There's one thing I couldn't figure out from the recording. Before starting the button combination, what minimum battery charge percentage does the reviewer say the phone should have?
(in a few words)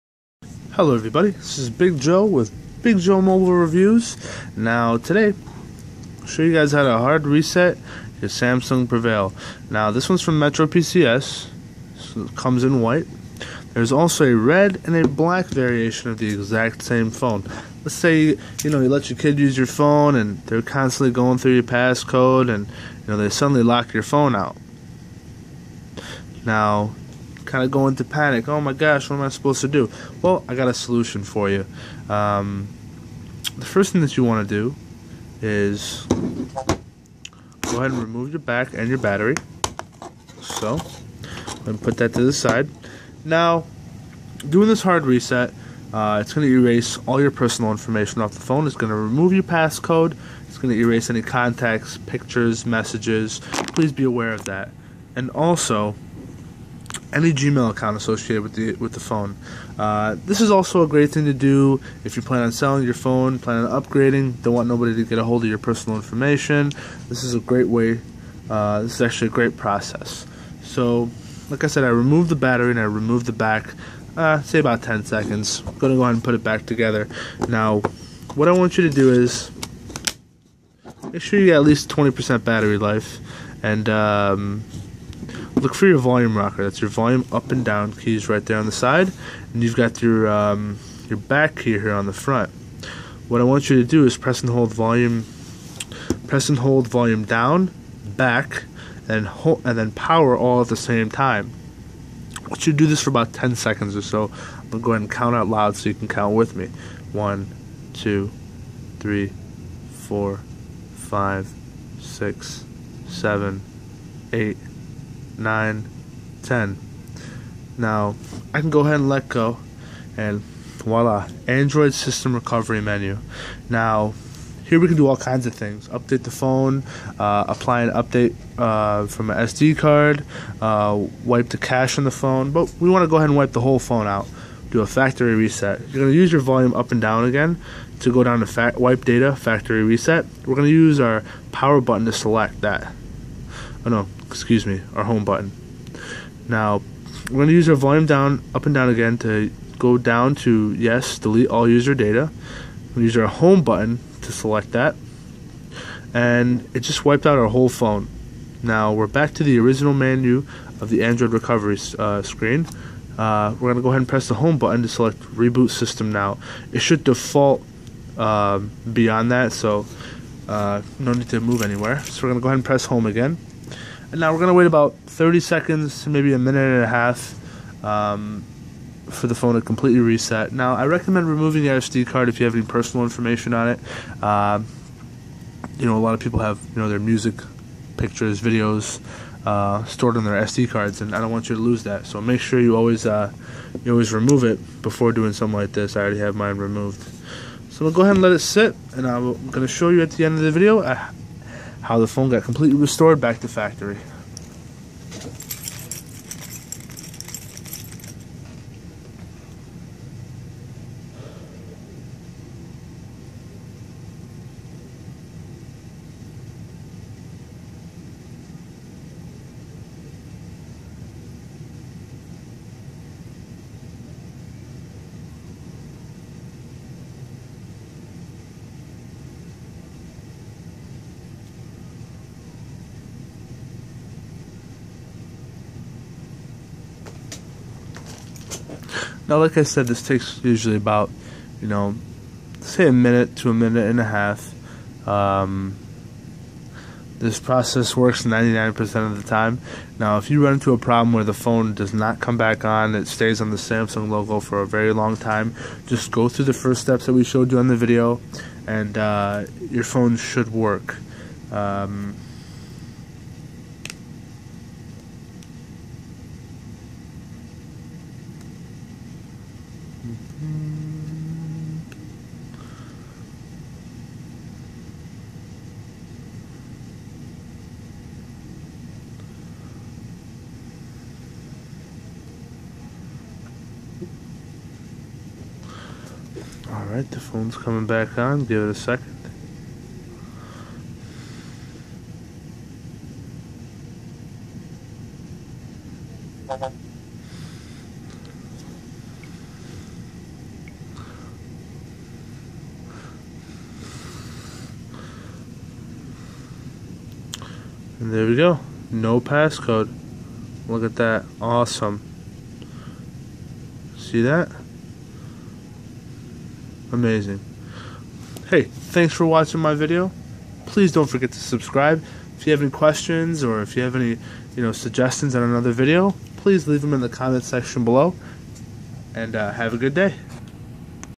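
20%.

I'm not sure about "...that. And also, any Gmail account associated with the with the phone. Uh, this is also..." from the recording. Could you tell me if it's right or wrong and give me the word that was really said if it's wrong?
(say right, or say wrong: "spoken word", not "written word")
right.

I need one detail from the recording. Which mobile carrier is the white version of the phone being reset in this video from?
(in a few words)
Metro PCS.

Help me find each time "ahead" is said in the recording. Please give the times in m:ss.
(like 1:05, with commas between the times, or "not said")
0:37, 1:16, 1:44, 1:58, 2:13, 2:43, 2:52, 3:18.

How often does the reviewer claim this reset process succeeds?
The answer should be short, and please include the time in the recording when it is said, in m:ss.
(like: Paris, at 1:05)
99% of the time, at 4:08.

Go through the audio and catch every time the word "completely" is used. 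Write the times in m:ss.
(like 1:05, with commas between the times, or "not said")
2:59, 3:22.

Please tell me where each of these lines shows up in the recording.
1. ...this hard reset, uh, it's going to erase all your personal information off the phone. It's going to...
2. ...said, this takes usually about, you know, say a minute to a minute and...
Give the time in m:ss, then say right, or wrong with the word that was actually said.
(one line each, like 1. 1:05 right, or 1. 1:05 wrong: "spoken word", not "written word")
1. 0:44 right
2. 3:59 right.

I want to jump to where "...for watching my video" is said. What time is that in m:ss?
5:19.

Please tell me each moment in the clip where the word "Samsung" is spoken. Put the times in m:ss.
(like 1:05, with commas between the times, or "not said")
0:08, 4:13.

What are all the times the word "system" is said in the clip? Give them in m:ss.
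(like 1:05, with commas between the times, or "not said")
2:01, 2:45.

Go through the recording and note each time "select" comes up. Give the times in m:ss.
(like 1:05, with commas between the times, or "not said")
2:22, 2:34, 2:44.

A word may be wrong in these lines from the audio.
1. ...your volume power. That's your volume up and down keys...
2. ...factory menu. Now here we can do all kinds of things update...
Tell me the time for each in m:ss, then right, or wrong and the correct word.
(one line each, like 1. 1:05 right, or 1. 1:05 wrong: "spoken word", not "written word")
1. 1:25 wrong: "rocker", not "power"
2. 2:02 wrong: "recovery", not "factory".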